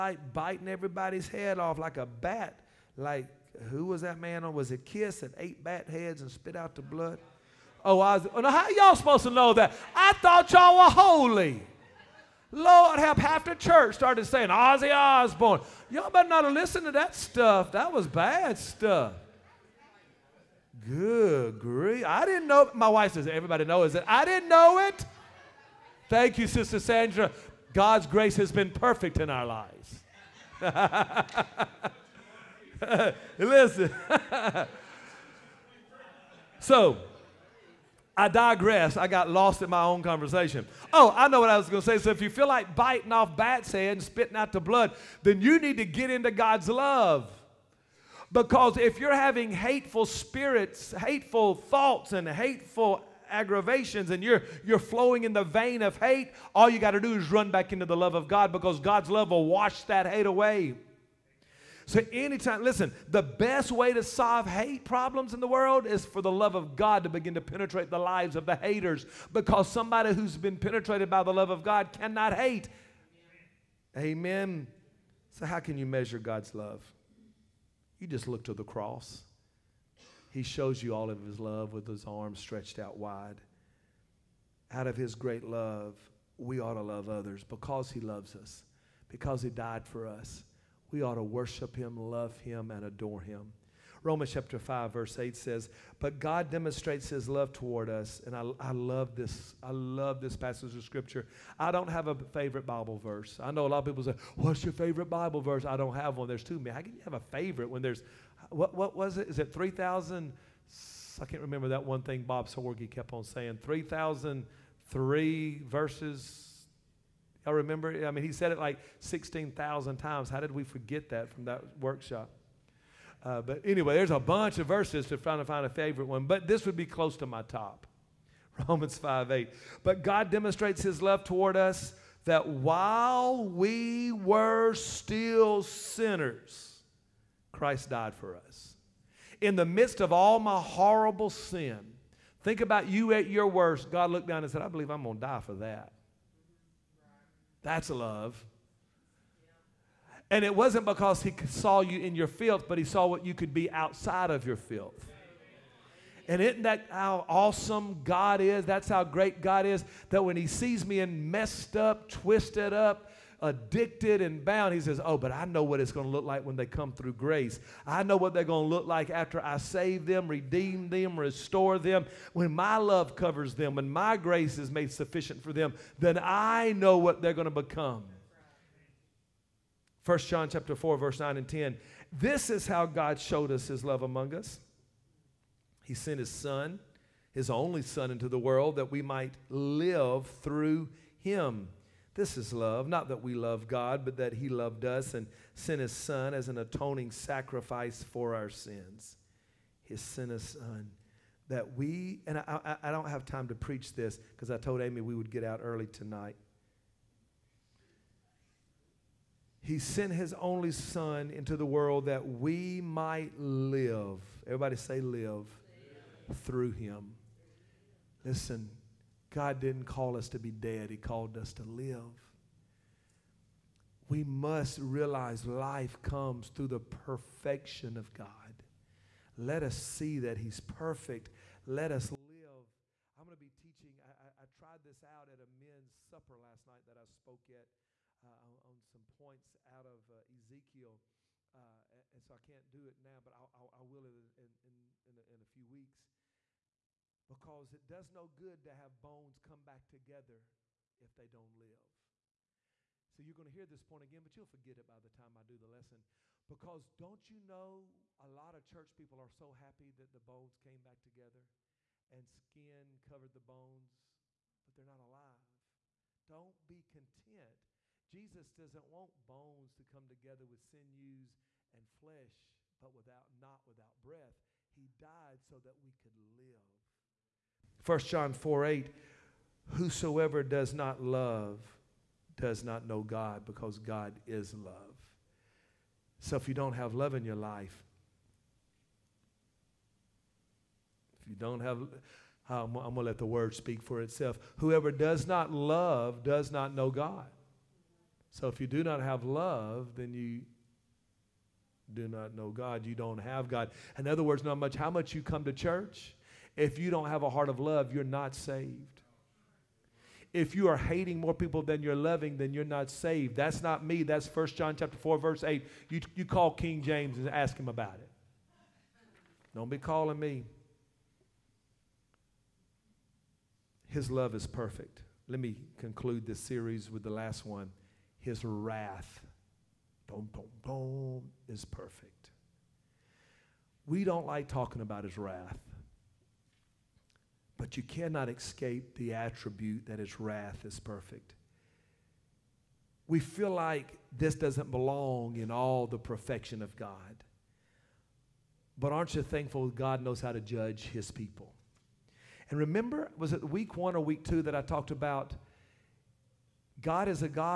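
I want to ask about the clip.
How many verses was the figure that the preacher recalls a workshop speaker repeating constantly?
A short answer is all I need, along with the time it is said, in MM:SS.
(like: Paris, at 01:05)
3,003, at 01:53.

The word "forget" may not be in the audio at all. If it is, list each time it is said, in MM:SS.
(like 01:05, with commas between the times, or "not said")
02:00, 04:14.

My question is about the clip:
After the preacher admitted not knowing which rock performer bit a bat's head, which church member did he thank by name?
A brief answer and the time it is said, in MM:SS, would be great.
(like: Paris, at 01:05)
Sister Sandra, at 00:26.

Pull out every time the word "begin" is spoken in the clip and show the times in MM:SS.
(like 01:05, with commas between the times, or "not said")
01:07.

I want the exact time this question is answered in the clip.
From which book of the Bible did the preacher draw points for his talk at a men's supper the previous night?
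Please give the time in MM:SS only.
04:00.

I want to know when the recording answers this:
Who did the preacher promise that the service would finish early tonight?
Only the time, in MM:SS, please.
03:24.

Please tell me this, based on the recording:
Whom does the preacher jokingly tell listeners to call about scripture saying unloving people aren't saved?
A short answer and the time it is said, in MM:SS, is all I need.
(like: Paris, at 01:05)
King James, at 05:16.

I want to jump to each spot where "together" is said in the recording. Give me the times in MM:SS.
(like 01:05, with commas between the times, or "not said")
04:09, 04:20, 04:30.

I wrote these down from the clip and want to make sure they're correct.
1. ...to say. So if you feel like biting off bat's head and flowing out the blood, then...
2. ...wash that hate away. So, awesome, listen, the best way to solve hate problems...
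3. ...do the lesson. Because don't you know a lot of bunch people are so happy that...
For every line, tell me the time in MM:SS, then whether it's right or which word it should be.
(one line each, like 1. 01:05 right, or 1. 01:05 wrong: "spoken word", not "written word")
1. 00:41 wrong: "spitting", not "flowing"
2. 00:59 wrong: "anytime", not "awesome"
3. 04:15 wrong: "church", not "bunch".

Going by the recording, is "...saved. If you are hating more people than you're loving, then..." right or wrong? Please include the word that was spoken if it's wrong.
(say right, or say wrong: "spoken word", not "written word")
right.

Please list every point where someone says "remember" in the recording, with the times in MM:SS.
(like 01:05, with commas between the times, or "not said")
01:51, 01:57, 05:52.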